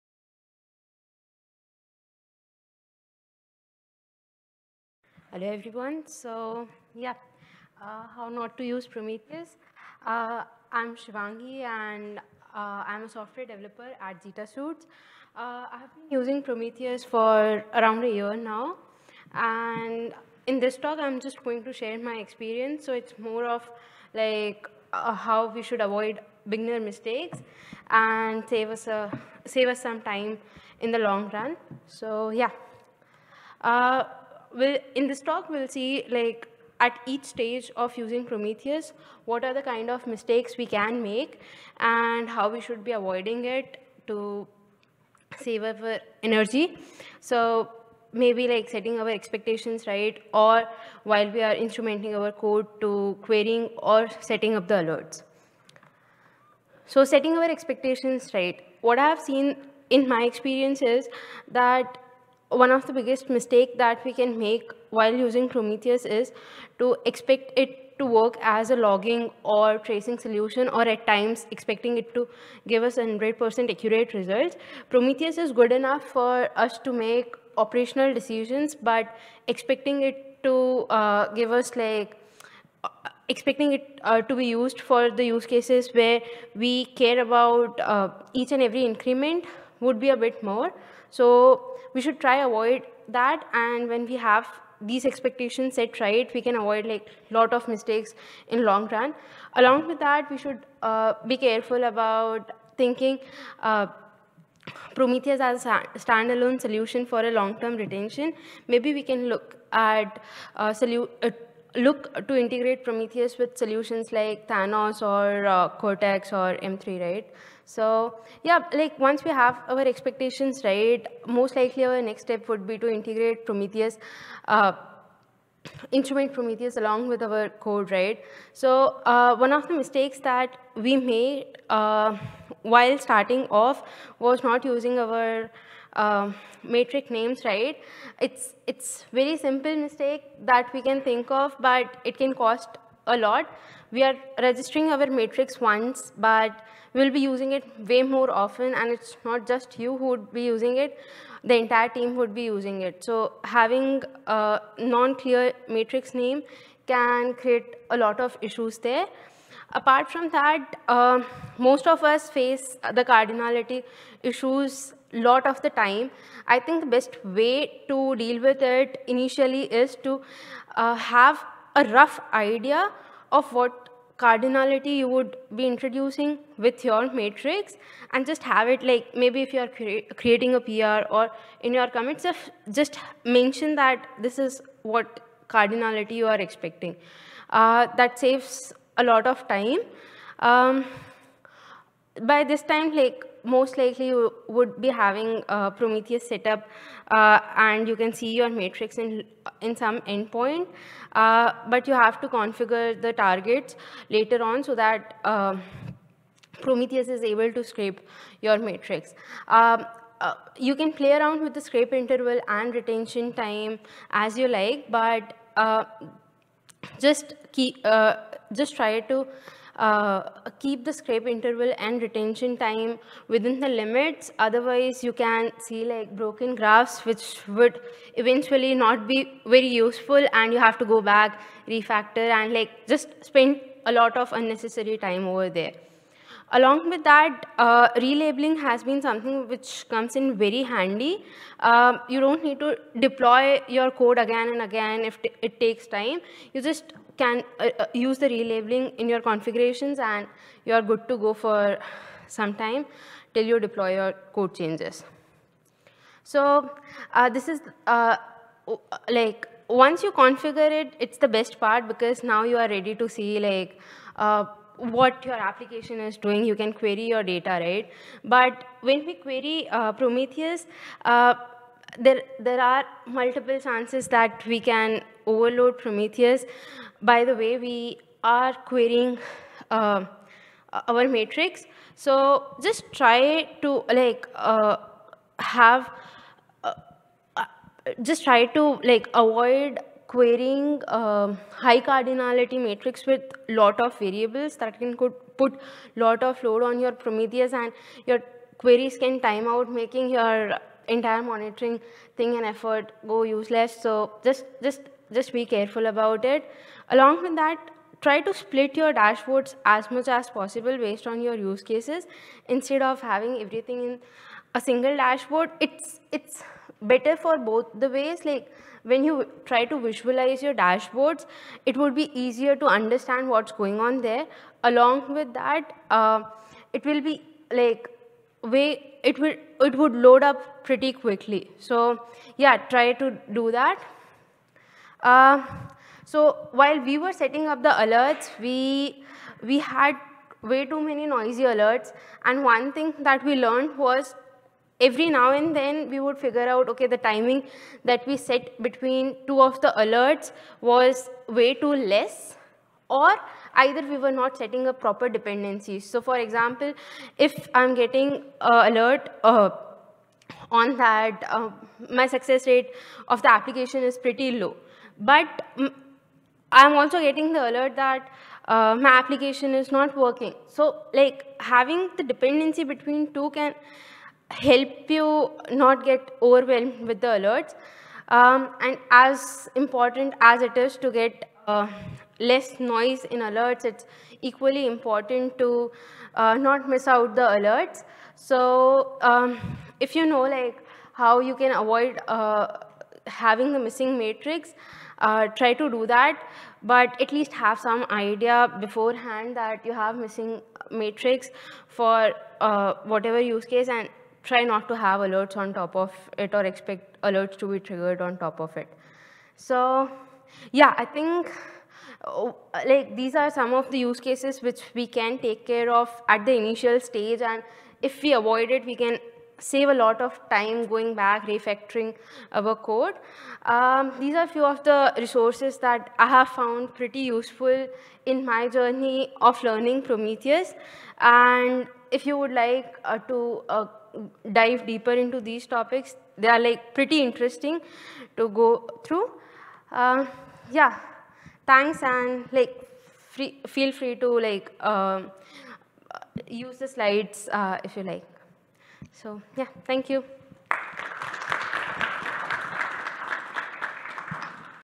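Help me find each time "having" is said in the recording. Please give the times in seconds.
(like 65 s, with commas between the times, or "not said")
153 s, 194 s, 313 s, 371 s, 393 s.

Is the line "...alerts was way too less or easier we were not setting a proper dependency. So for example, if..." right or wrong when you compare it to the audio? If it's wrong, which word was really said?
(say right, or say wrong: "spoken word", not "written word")
wrong: "either", not "easier".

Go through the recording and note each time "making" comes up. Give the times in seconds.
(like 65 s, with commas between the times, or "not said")
299 s.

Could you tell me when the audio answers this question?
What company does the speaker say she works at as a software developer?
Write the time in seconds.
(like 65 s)
14 s.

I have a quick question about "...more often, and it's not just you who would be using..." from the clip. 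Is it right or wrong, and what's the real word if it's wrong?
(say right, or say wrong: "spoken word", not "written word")
right.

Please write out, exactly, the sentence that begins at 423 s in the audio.
Um, these are few of the resources that I have found pretty useful in my journey of learning Prometheus.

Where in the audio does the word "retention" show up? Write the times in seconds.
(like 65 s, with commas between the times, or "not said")
107 s, 212 s, 222 s.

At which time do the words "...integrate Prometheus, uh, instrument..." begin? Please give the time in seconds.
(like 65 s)
122 s.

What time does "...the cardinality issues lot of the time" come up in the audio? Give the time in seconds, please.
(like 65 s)
162 s.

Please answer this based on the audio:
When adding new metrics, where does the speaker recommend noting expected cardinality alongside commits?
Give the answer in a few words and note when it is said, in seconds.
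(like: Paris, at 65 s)
PR, at 180 s.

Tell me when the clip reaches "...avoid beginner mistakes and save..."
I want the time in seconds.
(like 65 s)
25 s.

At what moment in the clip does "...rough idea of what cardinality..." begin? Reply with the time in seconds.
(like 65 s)
171 s.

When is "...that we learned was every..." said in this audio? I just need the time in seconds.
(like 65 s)
343 s.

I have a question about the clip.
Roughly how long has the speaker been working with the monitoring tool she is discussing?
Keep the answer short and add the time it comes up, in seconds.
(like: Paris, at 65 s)
around a year, at 17 s.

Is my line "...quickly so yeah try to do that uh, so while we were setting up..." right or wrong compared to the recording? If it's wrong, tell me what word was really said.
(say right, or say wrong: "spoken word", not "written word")
right.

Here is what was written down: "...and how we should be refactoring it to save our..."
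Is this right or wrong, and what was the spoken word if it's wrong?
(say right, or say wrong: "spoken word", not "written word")
wrong: "avoiding", not "refactoring".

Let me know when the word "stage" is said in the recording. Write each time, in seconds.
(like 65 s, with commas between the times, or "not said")
37 s, 416 s.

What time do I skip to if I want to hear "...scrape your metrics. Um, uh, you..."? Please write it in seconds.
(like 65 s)
207 s.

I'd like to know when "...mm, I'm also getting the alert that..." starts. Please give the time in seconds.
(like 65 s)
365 s.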